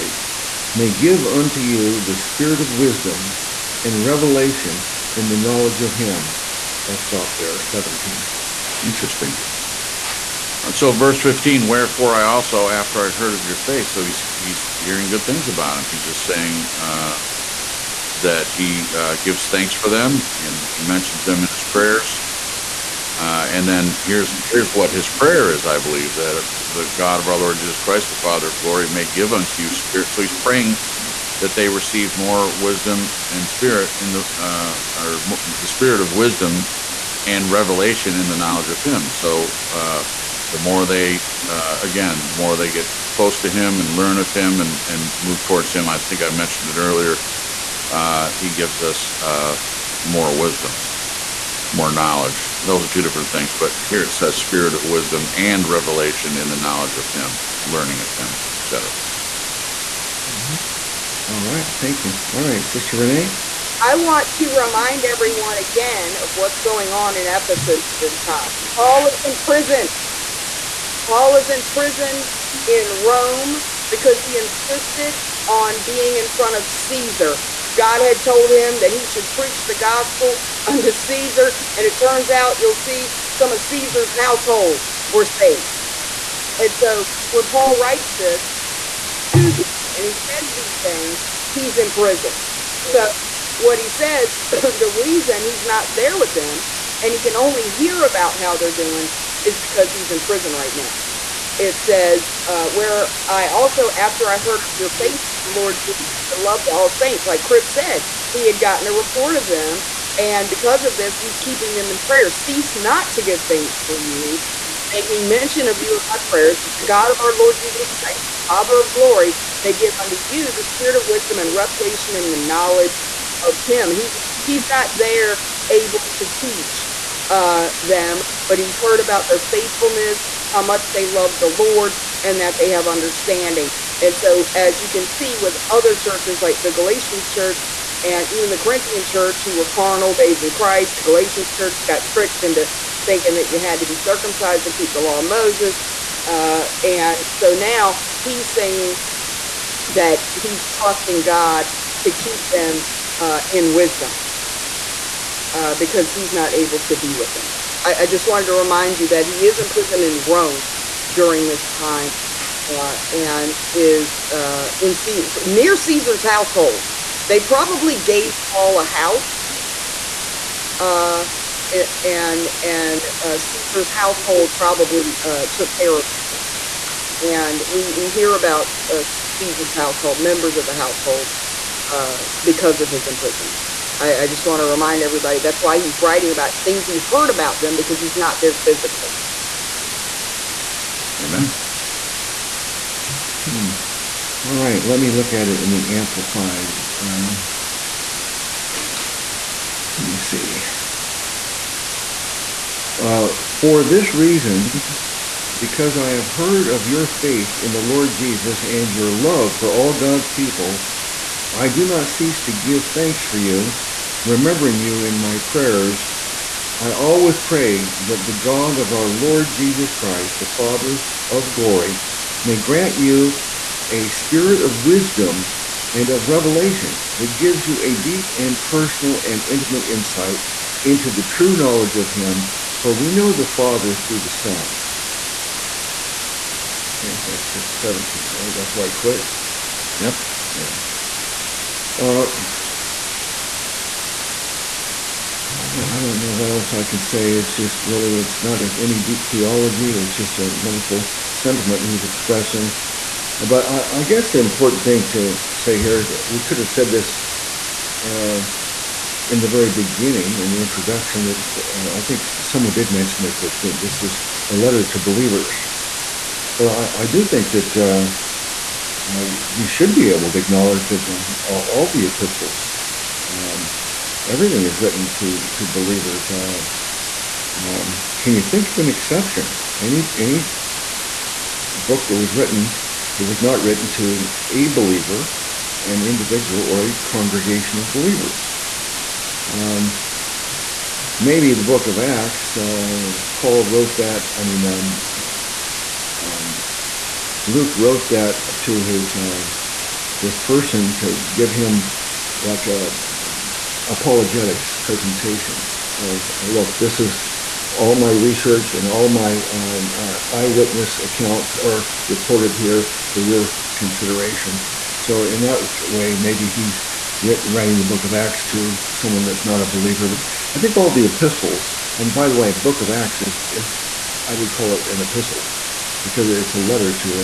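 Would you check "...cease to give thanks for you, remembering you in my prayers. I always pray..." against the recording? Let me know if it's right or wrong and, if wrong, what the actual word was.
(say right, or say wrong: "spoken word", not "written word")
right.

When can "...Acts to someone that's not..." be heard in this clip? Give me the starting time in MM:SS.
05:18.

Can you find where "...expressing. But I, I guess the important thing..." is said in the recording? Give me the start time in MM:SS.
04:12.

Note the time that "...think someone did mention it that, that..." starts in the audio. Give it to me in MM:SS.
04:22.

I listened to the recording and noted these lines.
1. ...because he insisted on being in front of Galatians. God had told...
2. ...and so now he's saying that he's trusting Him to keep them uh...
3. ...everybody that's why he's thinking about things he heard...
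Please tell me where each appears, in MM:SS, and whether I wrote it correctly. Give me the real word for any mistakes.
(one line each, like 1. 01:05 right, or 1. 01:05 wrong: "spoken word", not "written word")
1. 01:13 wrong: "Caesar", not "Galatians"
2. 02:26 wrong: "God", not "Him"
3. 03:05 wrong: "writing", not "thinking".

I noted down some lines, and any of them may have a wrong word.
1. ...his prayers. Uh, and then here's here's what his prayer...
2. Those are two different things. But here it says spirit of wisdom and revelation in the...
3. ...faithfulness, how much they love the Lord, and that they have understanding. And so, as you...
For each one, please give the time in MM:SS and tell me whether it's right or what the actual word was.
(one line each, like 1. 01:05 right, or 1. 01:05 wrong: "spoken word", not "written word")
1. 00:21 right
2. 00:52 right
3. 02:09 right.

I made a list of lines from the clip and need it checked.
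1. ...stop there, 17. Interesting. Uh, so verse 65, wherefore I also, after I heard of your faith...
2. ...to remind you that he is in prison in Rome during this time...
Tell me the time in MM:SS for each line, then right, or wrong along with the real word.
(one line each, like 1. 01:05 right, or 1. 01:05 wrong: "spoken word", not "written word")
1. 00:06 wrong: "15", not "65"
2. 02:38 right.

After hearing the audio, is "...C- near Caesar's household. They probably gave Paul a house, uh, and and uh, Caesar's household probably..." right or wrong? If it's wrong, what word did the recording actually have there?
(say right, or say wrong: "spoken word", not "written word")
right.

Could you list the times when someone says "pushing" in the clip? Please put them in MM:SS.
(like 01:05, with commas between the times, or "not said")
not said.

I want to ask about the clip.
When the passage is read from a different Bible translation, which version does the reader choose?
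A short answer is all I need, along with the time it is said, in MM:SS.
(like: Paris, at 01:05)
Amplified, at 03:15.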